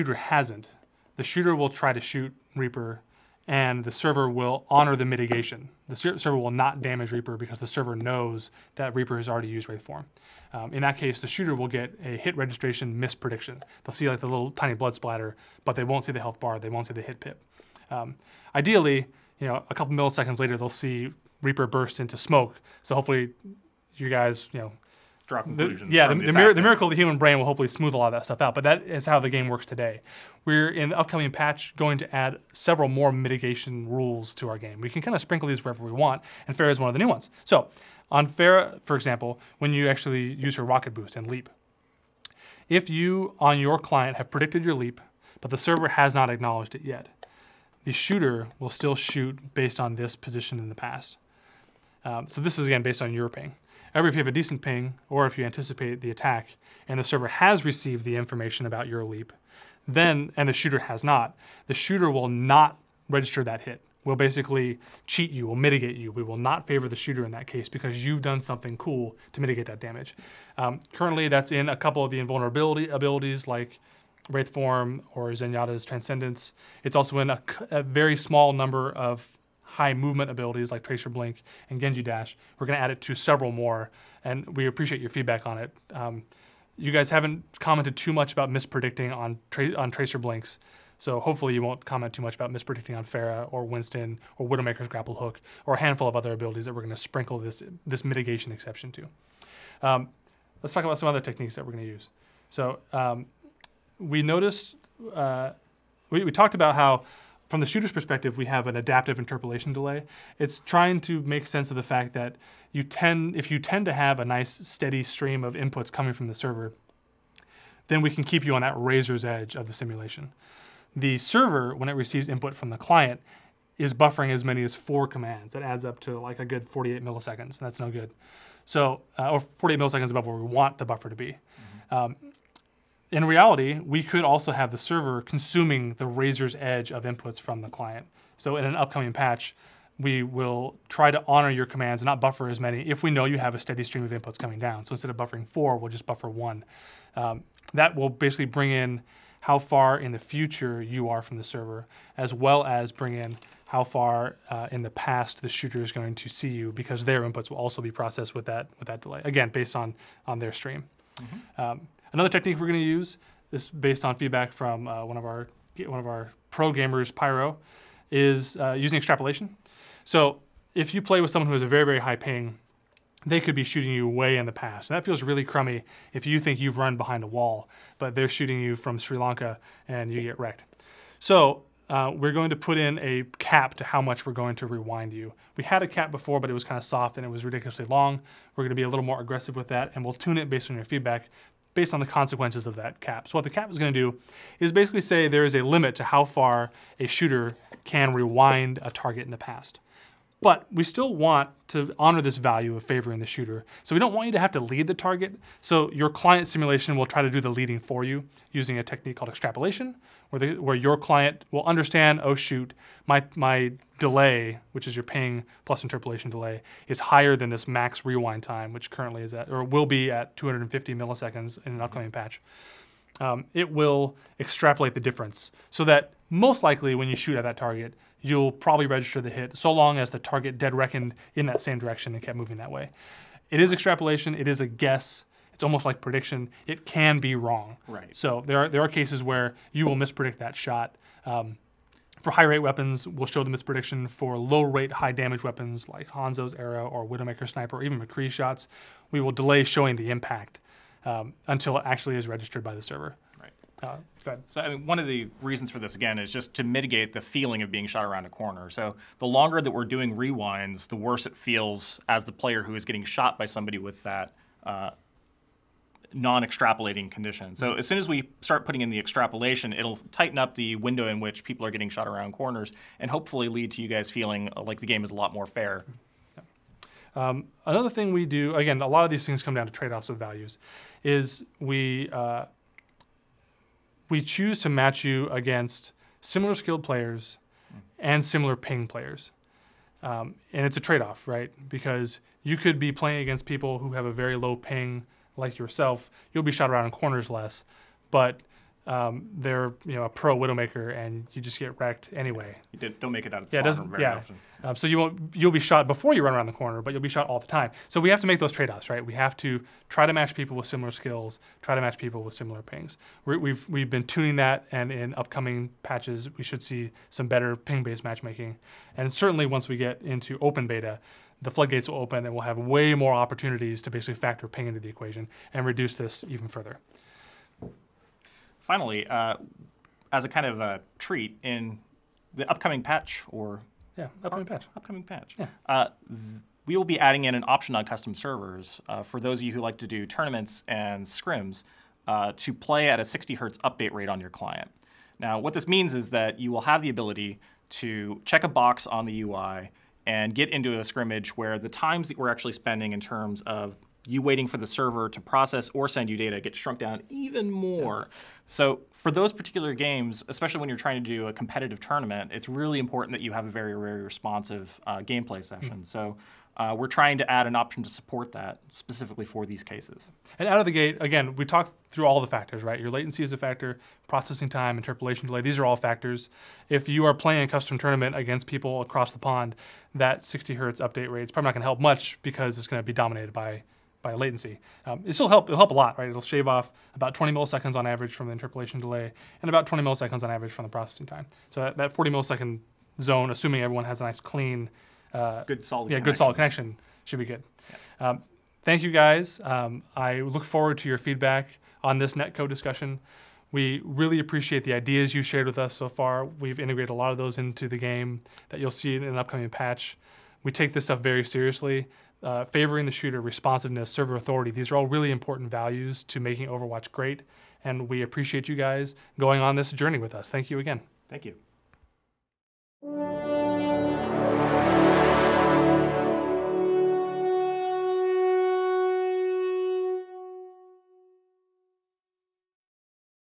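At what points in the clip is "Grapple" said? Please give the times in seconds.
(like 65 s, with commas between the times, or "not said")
94 s.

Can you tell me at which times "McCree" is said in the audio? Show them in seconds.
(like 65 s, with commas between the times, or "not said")
247 s.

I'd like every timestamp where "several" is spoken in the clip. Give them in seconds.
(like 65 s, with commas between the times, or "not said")
32 s, 83 s.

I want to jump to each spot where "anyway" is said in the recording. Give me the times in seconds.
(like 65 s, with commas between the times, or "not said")
302 s.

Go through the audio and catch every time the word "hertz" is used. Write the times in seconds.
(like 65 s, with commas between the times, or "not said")
343 s, 380 s.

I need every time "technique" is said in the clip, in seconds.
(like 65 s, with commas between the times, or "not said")
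101 s, 162 s, 208 s.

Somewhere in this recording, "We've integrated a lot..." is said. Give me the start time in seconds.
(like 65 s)
406 s.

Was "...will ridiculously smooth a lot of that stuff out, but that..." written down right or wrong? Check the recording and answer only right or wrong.
wrong.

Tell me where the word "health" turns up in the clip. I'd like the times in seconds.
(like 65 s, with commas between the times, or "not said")
16 s.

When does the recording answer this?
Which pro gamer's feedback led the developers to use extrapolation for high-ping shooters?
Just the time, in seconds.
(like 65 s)
167 s.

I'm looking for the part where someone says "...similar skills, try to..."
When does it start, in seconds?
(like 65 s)
310 s.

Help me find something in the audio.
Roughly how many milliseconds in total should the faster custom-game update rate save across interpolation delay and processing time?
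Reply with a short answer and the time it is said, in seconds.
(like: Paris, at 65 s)
40, at 391 s.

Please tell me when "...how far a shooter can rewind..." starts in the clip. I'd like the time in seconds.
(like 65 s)
196 s.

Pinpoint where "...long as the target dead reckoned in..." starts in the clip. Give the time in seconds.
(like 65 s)
229 s.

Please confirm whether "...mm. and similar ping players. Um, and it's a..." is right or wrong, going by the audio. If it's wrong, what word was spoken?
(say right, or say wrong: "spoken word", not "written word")
right.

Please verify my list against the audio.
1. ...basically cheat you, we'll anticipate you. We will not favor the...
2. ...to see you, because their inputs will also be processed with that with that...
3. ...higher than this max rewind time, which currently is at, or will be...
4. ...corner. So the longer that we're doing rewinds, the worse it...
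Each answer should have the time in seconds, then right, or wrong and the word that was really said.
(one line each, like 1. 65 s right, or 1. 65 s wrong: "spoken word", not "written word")
1. 64 s wrong: "mitigate", not "anticipate"
2. 156 s right
3. 216 s right
4. 258 s right.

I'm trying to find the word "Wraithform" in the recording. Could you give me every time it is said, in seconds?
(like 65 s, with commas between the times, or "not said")
9 s, 74 s.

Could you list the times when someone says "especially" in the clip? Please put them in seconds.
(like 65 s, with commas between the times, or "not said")
360 s.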